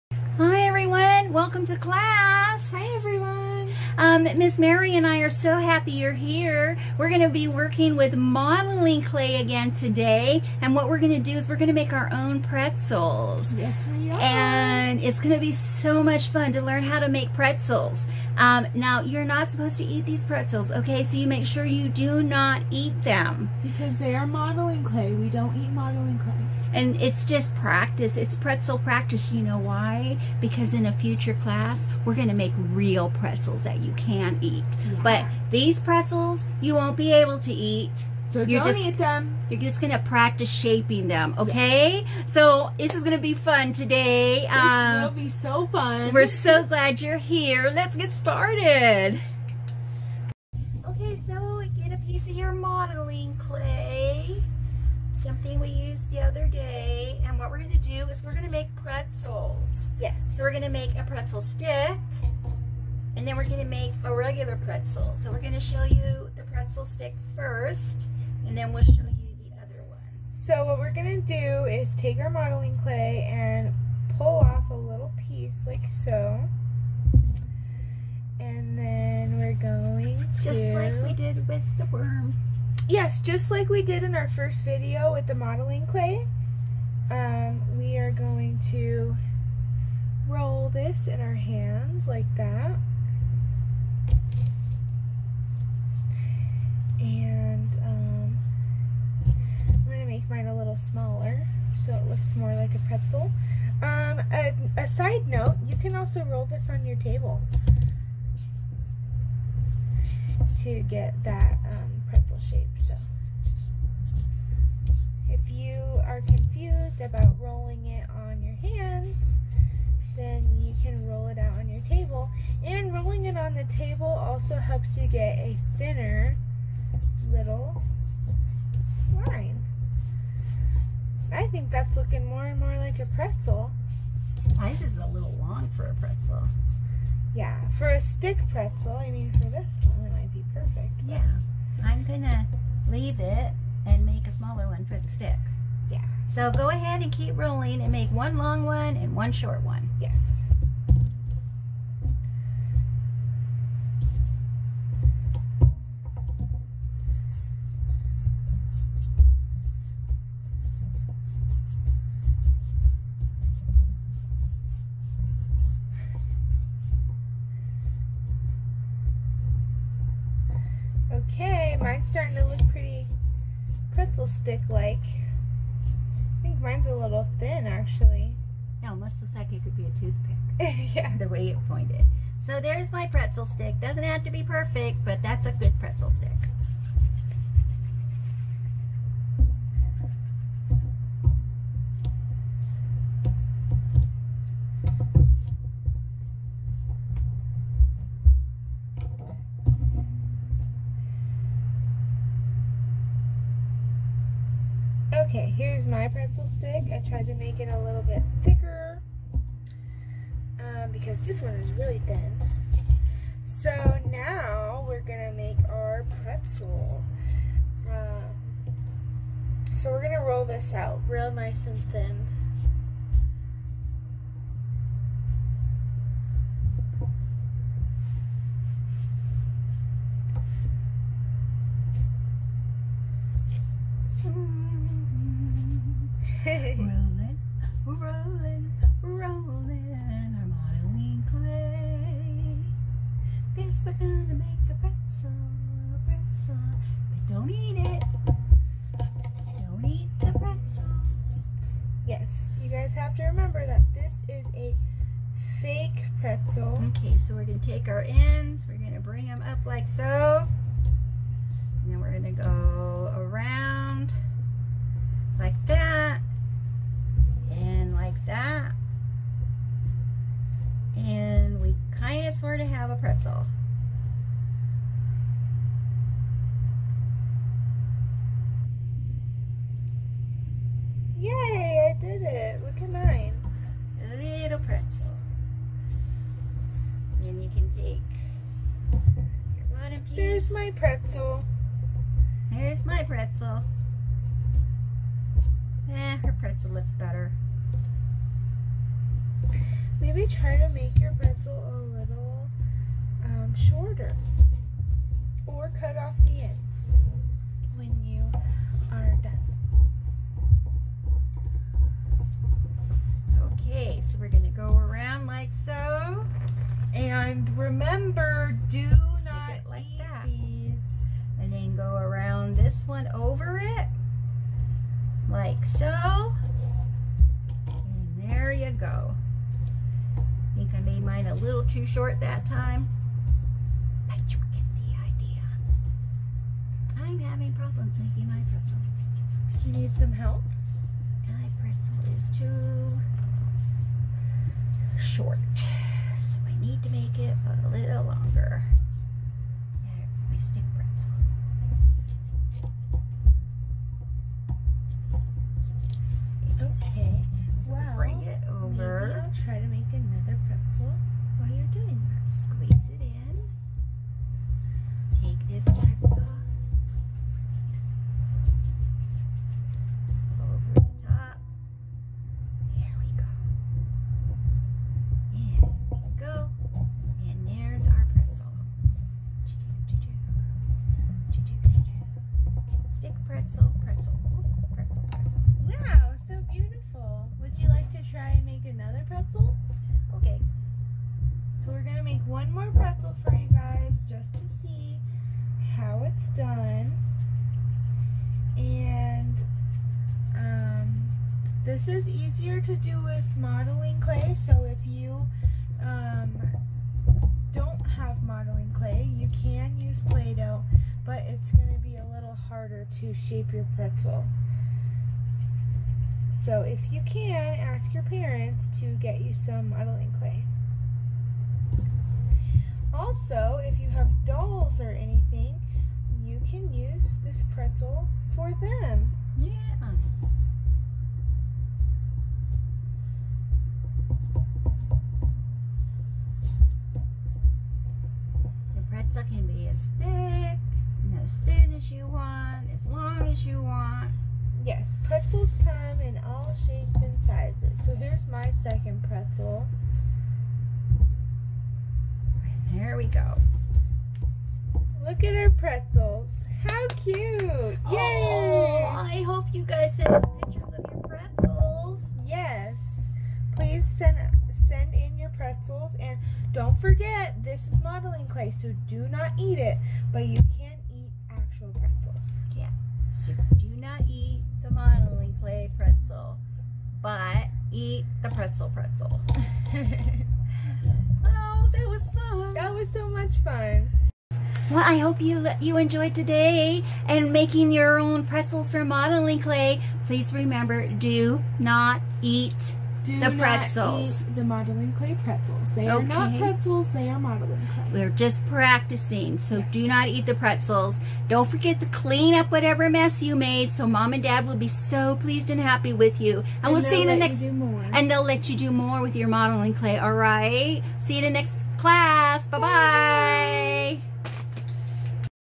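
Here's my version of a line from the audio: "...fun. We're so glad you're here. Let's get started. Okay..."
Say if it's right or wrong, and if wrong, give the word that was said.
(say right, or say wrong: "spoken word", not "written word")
right.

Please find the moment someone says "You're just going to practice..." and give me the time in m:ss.
0:39.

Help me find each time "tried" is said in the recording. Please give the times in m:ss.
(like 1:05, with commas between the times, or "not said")
3:27.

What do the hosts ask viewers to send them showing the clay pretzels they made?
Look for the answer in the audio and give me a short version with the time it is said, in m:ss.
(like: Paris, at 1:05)
pictures, at 7:40.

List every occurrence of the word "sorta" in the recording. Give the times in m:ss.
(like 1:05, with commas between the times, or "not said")
4:32.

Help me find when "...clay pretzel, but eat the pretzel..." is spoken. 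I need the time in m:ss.
7:55.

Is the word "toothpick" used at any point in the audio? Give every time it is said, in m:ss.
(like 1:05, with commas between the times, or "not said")
2:59.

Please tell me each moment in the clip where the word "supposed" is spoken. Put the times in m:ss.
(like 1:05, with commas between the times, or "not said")
0:19.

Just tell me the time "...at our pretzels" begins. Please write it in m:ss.
7:35.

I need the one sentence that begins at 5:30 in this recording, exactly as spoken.
I think I made mine a little too short that time.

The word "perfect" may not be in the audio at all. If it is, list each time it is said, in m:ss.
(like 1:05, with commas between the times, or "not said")
2:20, 3:04.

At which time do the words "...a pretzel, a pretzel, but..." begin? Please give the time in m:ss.
4:04.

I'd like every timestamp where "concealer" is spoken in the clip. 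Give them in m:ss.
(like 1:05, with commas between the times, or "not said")
not said.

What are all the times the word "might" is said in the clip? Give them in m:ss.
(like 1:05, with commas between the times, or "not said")
2:20.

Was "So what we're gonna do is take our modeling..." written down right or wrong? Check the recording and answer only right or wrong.
right.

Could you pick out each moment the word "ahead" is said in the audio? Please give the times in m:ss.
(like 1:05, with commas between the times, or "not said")
2:26.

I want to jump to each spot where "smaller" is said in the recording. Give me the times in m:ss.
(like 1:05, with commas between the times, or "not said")
1:40, 2:24.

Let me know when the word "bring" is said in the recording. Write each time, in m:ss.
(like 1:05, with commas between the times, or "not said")
4:18, 5:57.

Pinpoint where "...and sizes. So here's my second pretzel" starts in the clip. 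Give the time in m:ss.
7:27.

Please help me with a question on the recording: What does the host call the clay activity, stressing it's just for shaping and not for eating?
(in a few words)
pretzel practice.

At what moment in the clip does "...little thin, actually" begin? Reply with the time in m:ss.
2:56.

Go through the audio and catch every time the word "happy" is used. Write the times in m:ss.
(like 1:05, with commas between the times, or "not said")
0:05, 8:25.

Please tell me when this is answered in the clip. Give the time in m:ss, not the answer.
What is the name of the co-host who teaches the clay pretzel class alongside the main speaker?
0:04.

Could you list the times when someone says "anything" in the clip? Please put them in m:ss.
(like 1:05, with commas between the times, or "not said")
7:04.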